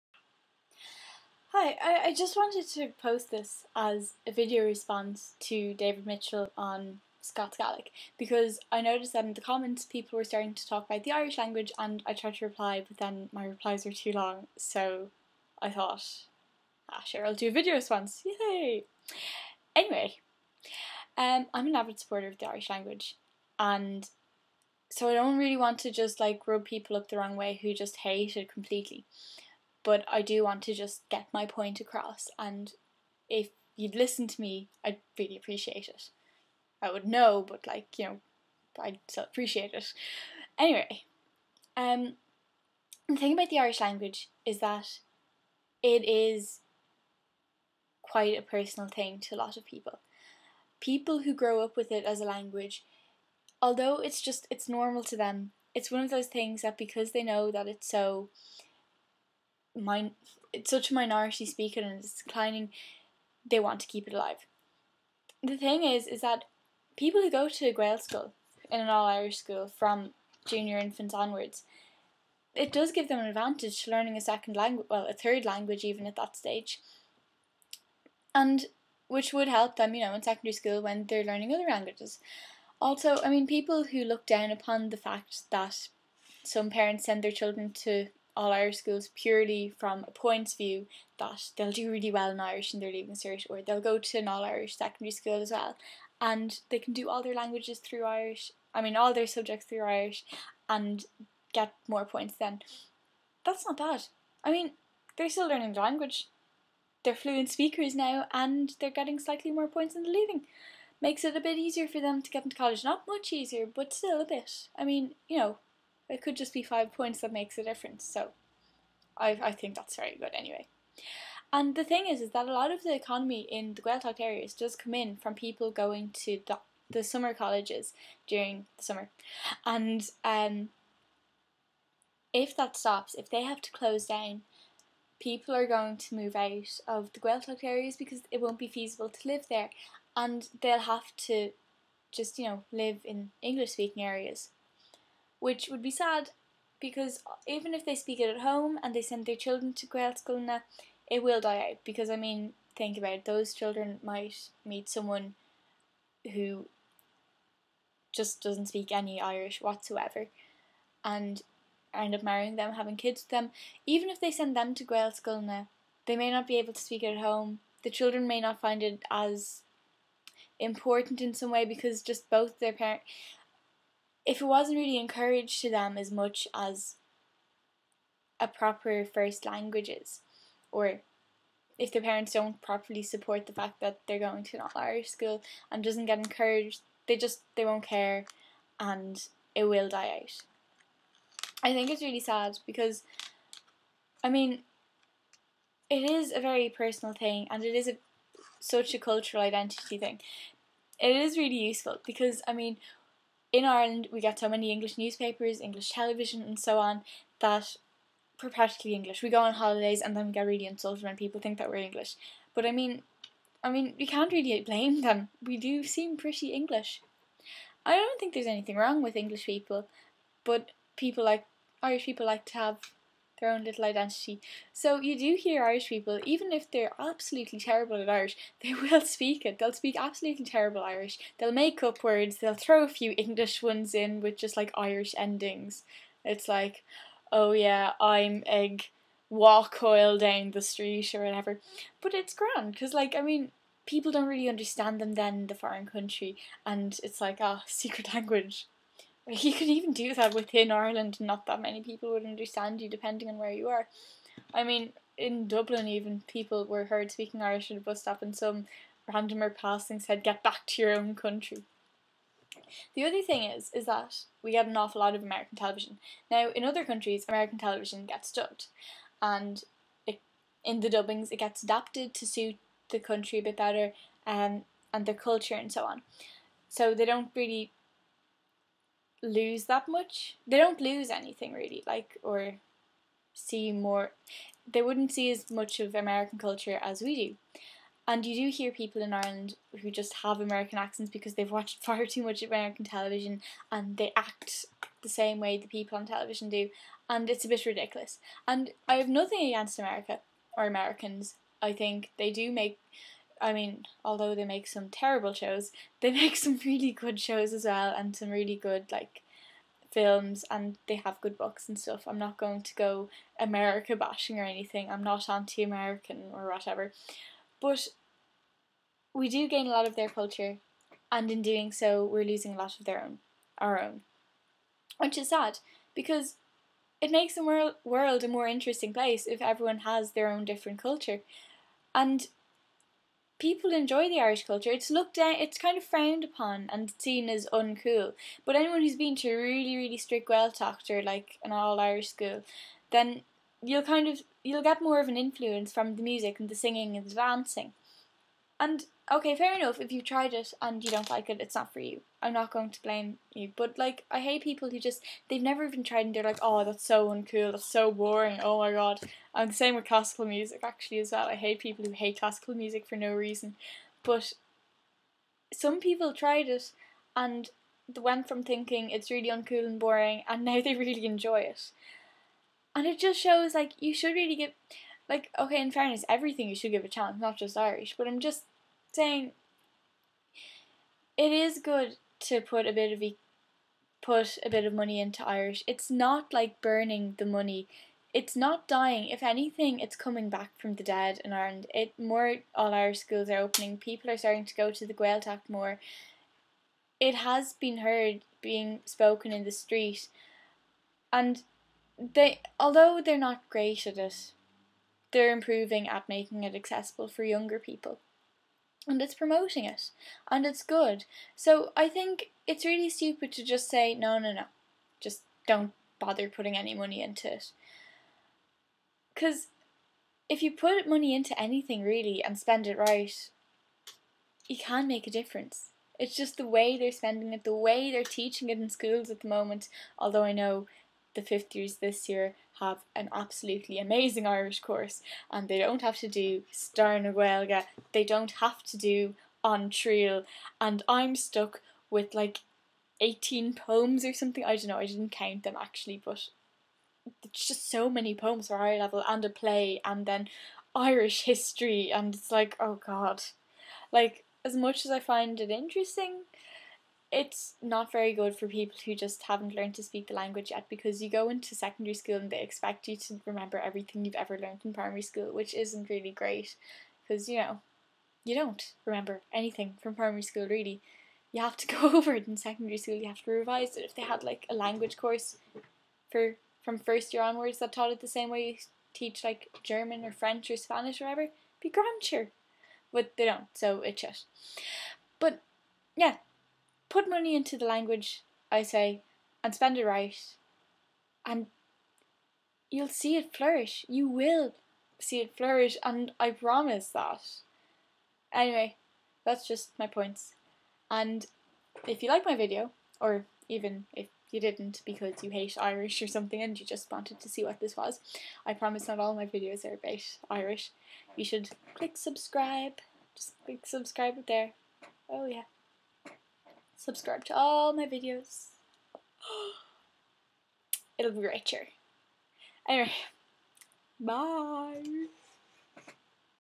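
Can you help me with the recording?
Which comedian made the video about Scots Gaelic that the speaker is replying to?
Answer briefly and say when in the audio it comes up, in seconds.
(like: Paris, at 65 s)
David Mitchell, at 5 s.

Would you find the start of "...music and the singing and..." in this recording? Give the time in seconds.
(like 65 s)
346 s.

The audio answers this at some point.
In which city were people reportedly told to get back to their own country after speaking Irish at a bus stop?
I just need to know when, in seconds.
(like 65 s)
255 s.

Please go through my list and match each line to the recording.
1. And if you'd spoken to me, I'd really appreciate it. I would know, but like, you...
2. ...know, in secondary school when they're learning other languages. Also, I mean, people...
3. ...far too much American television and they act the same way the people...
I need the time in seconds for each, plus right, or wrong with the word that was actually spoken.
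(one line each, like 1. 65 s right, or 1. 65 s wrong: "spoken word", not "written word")
1. 32 s wrong: "listen", not "spoken"
2. 80 s right
3. 291 s right.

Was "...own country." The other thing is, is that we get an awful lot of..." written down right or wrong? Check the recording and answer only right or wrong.
right.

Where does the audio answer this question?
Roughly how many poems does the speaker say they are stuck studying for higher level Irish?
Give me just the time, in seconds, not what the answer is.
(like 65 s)
443 s.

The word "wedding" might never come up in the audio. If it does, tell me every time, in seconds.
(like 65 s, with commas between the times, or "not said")
not said.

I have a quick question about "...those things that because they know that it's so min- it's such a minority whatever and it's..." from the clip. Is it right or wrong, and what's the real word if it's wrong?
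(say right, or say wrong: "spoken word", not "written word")
wrong: "speaker", not "whatever".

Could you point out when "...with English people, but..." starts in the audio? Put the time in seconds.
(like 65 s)
219 s.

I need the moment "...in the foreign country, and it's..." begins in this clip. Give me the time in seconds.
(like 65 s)
245 s.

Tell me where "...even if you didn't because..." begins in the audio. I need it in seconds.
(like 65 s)
503 s.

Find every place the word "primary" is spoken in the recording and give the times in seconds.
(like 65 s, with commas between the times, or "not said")
464 s, 469 s.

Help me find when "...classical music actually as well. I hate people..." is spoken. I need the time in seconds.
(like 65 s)
359 s.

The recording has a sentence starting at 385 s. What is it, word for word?
It's not like burning the money.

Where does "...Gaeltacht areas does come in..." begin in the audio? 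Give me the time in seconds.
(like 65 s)
123 s.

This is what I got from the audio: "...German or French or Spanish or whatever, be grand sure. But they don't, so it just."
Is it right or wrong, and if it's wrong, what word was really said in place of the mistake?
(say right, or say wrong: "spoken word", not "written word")
right.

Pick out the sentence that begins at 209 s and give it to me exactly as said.
We go on holidays and then we get really insulted when people think that we're English.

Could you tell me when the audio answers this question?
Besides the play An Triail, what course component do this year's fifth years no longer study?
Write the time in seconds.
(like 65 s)
436 s.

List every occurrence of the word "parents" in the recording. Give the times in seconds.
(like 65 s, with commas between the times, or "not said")
86 s, 172 s, 182 s.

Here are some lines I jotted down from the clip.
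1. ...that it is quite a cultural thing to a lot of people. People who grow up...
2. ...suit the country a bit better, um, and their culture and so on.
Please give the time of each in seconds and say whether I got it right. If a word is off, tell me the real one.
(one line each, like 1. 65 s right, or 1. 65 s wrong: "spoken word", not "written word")
1. 44 s wrong: "personal", not "cultural"
2. 272 s right.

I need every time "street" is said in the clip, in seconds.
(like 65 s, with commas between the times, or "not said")
240 s, 399 s.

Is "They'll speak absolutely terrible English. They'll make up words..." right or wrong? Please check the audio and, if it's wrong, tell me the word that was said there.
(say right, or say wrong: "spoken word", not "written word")
wrong: "Irish", not "English".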